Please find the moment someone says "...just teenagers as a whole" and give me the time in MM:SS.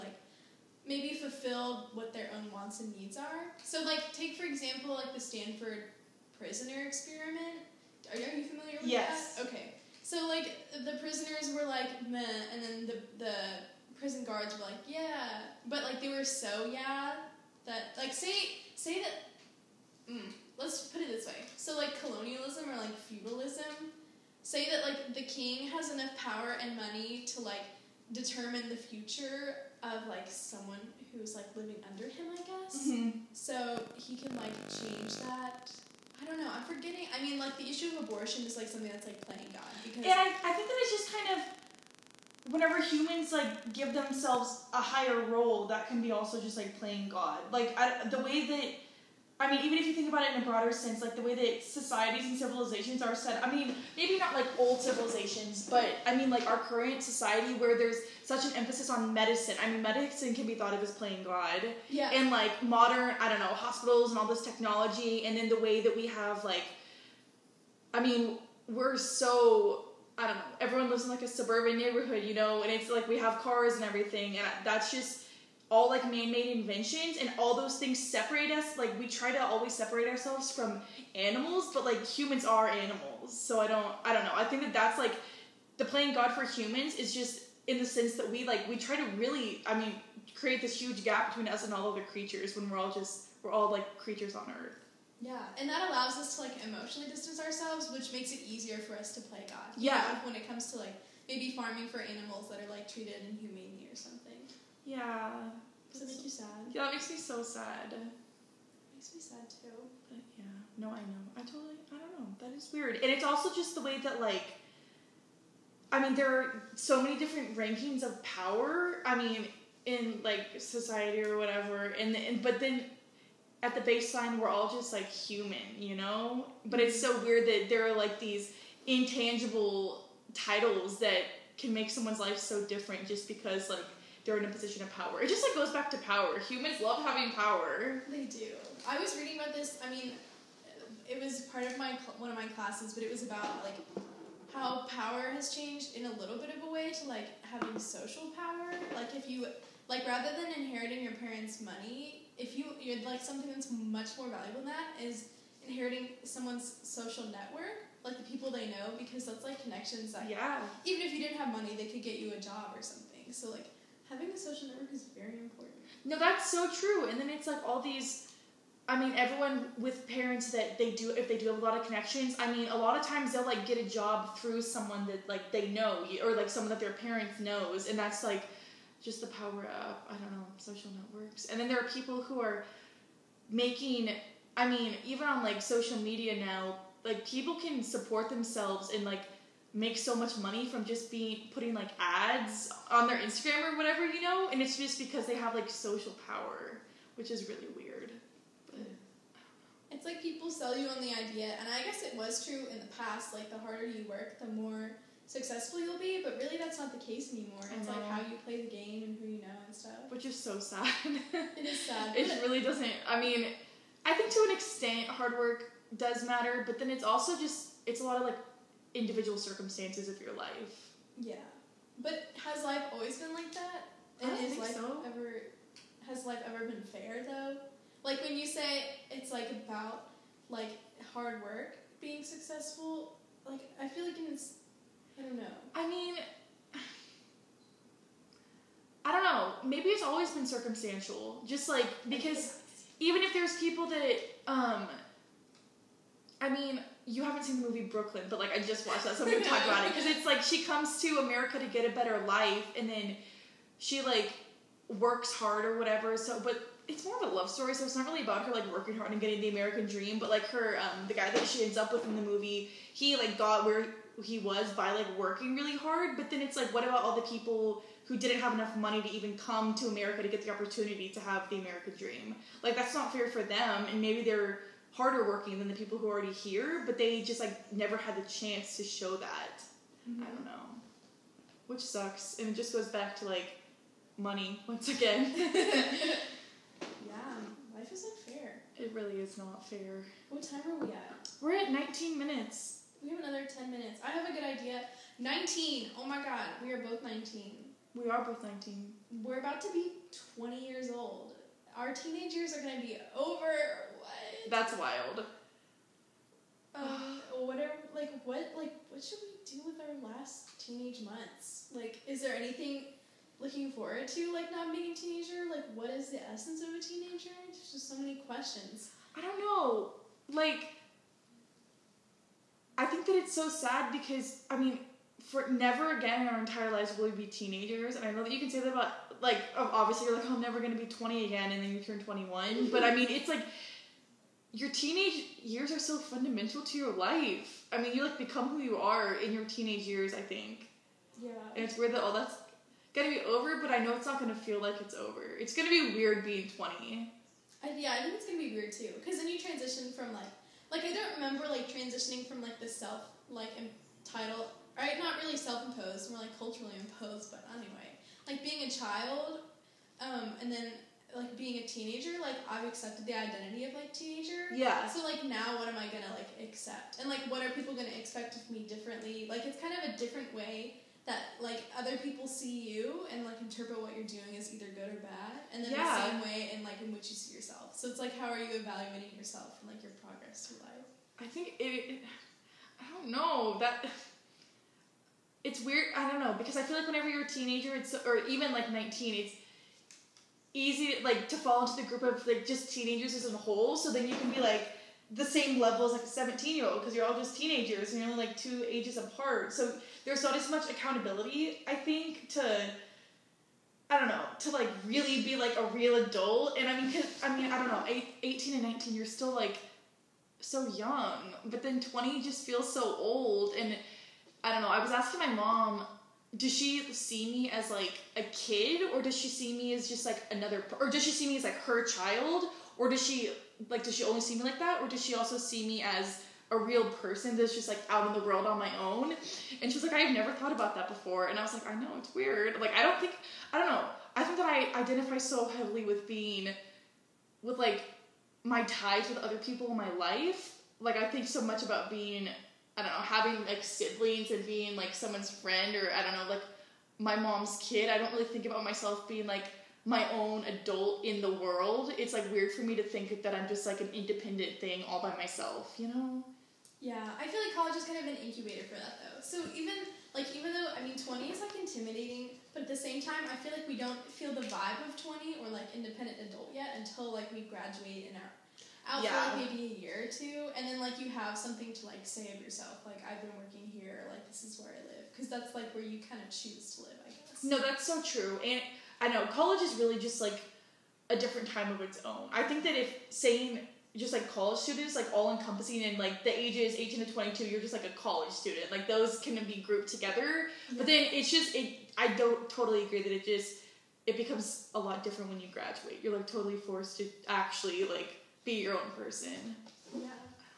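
06:32.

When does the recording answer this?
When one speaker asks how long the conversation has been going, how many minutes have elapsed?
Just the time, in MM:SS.
04:51.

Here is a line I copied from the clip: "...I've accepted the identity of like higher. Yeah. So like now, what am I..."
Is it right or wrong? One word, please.
wrong.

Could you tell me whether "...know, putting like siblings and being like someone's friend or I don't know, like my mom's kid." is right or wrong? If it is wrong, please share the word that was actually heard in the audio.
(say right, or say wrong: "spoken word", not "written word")
wrong: "having", not "putting".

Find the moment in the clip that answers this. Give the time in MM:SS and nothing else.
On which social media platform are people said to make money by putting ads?
03:13.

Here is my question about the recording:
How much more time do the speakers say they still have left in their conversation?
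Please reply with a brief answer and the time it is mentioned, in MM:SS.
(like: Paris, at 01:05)
10 minutes, at 04:53.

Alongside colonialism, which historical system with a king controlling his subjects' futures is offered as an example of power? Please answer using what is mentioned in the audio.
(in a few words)
Feudalism.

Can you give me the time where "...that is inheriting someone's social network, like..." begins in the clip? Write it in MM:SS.
02:34.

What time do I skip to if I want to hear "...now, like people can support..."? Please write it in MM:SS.
03:06.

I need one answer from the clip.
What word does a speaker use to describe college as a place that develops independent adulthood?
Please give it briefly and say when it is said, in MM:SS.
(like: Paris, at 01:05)
Incubator, at 07:38.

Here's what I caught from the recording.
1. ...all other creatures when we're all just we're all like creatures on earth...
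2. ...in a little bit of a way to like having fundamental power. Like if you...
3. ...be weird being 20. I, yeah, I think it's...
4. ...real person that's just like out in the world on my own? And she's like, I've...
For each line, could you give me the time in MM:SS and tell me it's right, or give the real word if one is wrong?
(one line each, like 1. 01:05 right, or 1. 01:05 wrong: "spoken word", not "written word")
1. 01:31 right
2. 02:25 wrong: "social", not "fundamental"
3. 05:45 right
4. 07:06 right.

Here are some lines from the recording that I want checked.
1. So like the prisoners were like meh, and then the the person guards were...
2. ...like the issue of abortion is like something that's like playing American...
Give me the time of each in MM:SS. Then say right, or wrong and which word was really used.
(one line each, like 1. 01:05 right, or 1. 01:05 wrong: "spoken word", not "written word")
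1. 00:10 wrong: "prison", not "person"
2. 00:37 wrong: "God", not "American".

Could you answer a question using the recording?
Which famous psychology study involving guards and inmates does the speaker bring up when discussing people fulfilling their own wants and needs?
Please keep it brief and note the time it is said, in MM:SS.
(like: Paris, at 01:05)
Stanford prisoner experiment, at 00:05.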